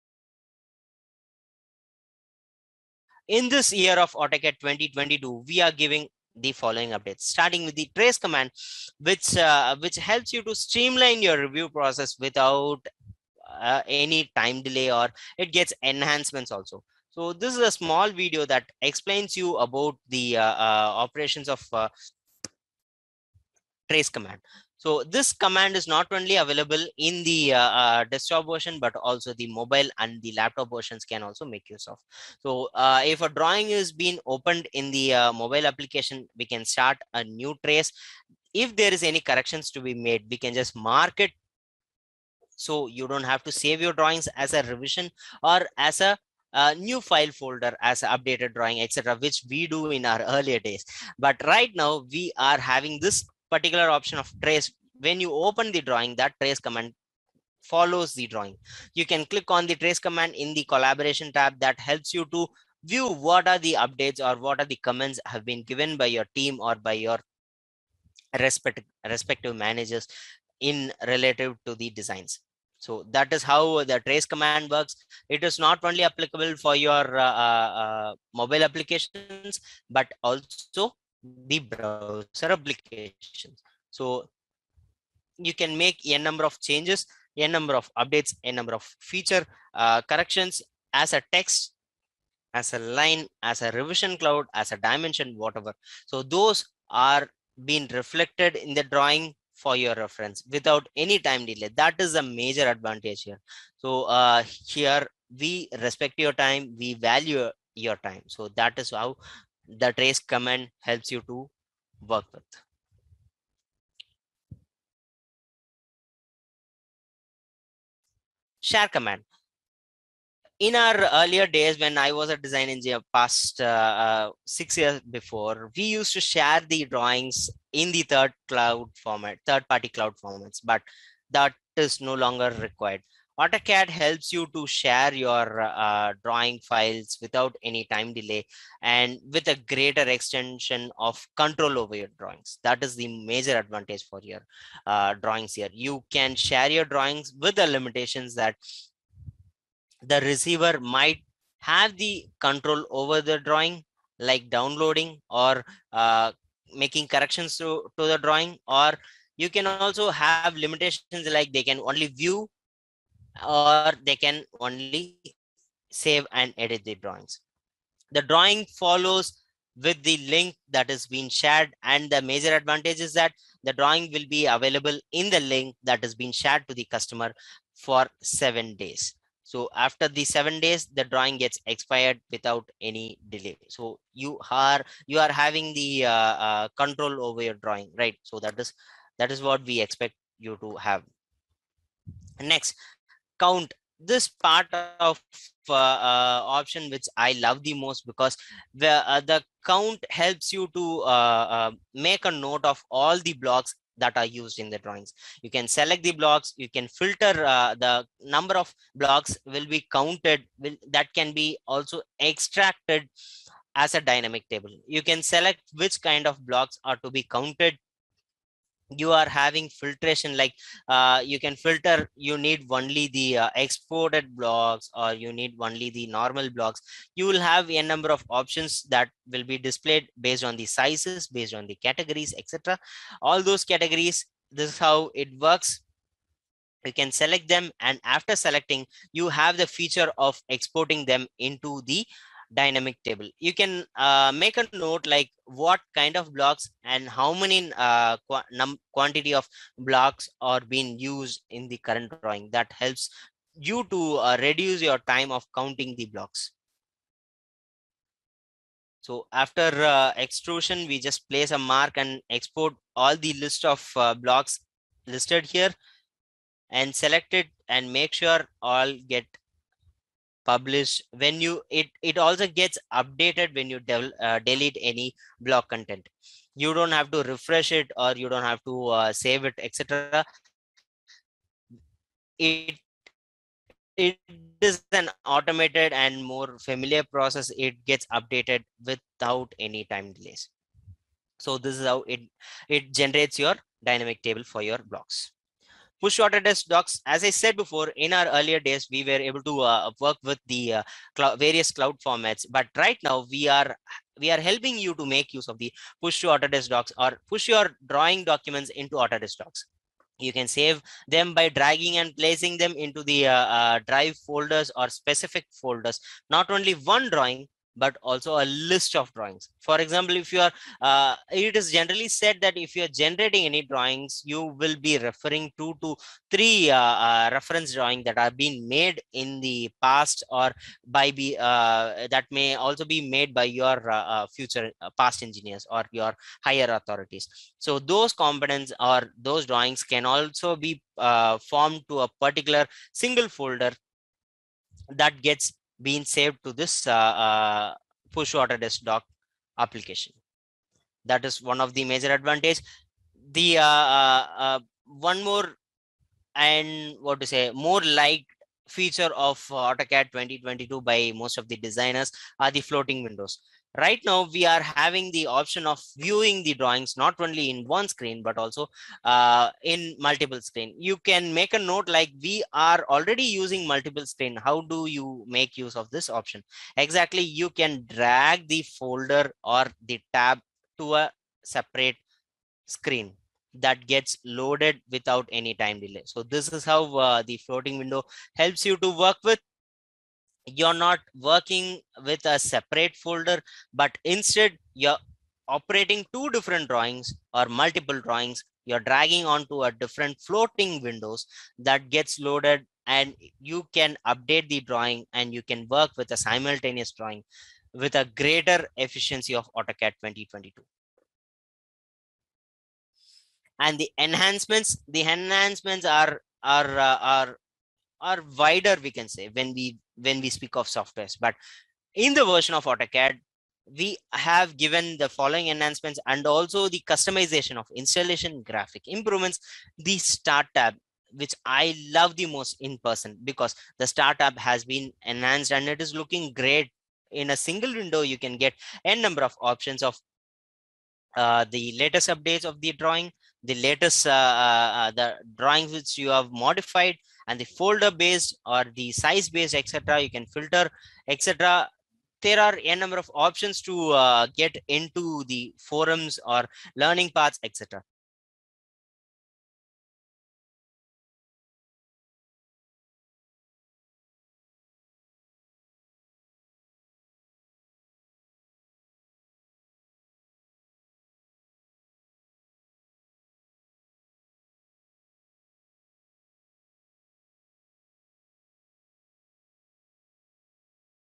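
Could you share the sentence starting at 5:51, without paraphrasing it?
That is one of the major advantage.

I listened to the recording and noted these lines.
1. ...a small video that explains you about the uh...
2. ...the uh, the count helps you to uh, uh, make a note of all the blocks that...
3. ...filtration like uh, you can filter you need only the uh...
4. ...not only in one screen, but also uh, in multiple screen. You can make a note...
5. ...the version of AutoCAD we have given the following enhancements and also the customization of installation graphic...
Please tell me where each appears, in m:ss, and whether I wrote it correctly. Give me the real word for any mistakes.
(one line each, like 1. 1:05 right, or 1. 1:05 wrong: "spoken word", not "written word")
1. 0:17 right
2. 3:18 right
3. 3:39 right
4. 6:07 right
5. 7:02 right.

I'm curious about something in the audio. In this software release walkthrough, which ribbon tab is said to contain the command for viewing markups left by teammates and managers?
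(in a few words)
Collaboration.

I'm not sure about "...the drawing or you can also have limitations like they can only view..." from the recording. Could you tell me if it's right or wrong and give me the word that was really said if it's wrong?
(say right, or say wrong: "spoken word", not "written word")
right.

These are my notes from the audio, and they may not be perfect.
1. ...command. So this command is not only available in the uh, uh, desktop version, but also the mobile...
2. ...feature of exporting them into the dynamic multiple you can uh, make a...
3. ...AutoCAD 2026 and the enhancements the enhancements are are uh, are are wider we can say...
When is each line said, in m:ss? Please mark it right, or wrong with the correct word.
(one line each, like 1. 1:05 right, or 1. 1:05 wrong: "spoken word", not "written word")
1. 0:24 right
2. 3:59 wrong: "table", not "multiple"
3. 6:49 wrong: "2022", not "2026".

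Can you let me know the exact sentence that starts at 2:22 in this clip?
That is the major advantage for your uh, drawings here.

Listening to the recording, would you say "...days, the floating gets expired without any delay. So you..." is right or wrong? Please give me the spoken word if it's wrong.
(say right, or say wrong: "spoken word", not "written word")
wrong: "drawing", not "floating".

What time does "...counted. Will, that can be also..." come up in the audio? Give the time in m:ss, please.
3:29.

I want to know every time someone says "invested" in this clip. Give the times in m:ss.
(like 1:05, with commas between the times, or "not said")
not said.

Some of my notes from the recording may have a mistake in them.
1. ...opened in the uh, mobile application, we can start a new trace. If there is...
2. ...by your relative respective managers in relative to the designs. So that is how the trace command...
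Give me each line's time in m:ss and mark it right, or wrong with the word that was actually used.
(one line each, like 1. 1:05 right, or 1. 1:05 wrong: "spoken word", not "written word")
1. 0:34 right
2. 1:06 wrong: "respective", not "relative".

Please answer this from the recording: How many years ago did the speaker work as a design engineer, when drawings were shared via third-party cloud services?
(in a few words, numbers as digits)
6.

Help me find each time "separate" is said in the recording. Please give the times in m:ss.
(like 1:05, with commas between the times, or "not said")
6:21, 6:32.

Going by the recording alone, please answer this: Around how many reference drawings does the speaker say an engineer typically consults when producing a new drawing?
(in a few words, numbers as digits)
3.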